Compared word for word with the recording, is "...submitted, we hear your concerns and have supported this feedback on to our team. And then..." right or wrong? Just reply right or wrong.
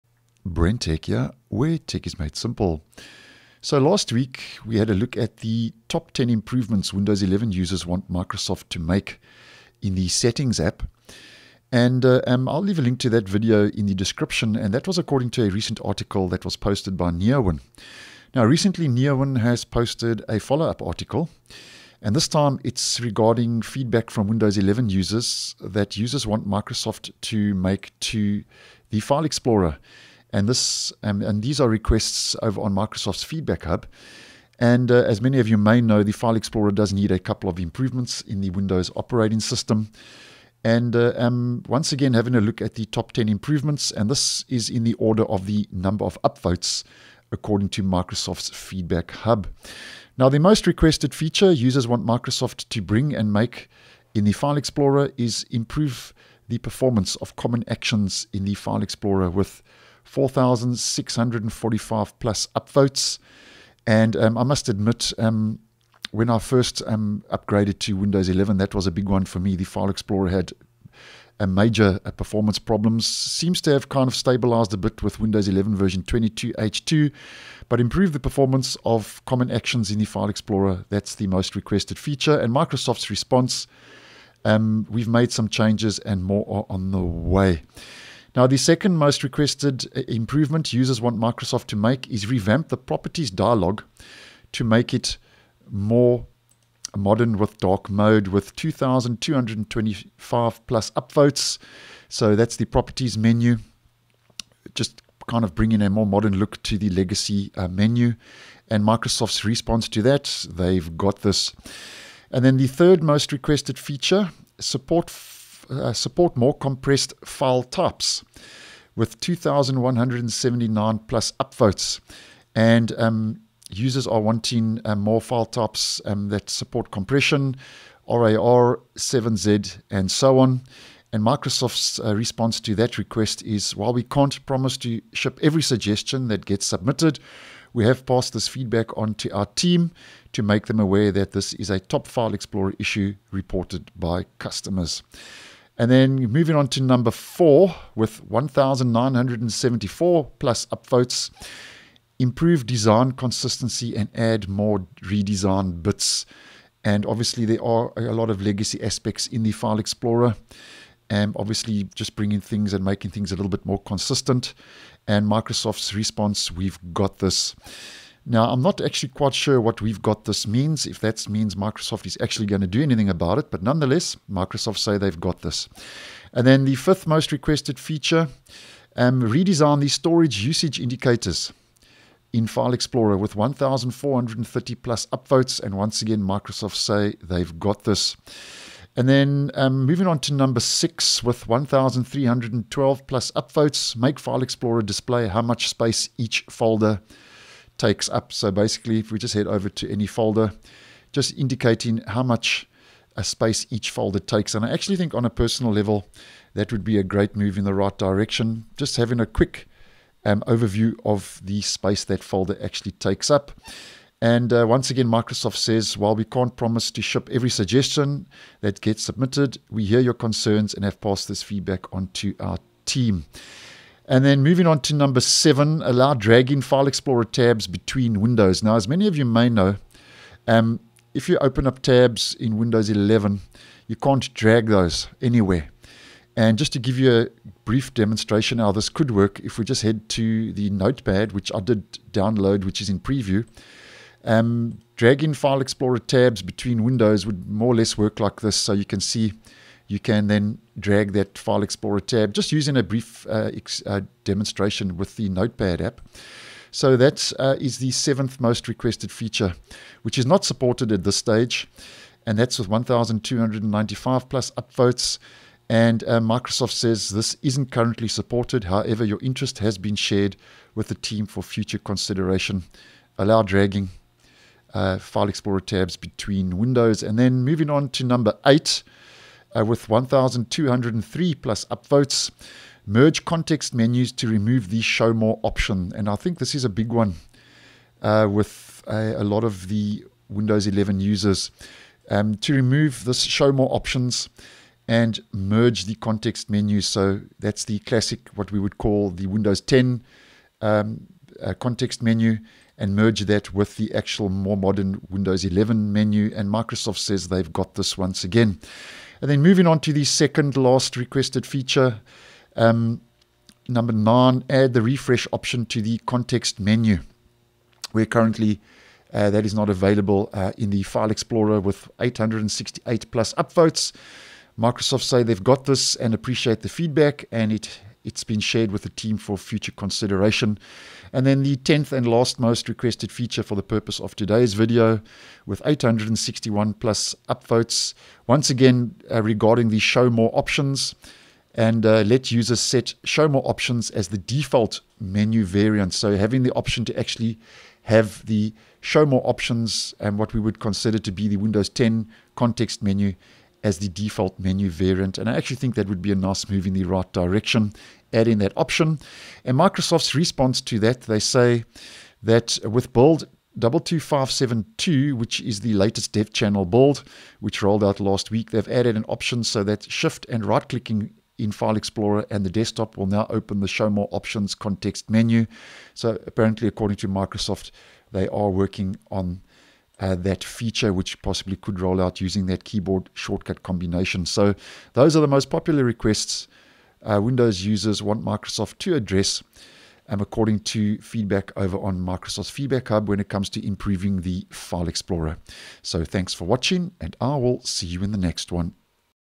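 wrong.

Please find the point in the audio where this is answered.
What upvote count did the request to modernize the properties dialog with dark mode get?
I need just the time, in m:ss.
1:38.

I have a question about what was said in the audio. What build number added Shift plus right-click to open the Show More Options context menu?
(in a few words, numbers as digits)
22572.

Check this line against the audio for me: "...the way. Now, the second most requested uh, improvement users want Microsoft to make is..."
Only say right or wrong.
right.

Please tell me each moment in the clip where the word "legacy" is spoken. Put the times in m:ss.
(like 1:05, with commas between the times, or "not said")
1:46, 2:38.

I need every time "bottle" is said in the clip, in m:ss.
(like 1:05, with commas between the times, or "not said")
not said.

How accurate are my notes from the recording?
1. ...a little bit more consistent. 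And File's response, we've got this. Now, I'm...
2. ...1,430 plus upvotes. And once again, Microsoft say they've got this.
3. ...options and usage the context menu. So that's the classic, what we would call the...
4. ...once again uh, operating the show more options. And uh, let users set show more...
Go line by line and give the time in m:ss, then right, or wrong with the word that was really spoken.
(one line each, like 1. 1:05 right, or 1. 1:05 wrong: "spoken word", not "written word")
1. 2:43 wrong: "Microsoft", not "File"
2. 3:03 right
3. 4:53 wrong: "merge", not "usage"
4. 5:38 wrong: "regarding", not "operating".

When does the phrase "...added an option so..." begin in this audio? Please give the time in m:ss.
6:08.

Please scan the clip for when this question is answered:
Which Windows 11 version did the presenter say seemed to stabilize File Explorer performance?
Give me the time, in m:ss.
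1:16.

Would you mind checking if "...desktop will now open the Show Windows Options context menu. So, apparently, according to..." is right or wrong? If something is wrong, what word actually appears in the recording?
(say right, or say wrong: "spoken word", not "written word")
wrong: "More", not "Windows".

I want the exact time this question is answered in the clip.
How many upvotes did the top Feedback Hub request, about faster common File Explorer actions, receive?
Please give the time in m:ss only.
1:00.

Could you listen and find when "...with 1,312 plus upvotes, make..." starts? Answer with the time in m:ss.
3:11.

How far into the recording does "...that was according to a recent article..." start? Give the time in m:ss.
0:14.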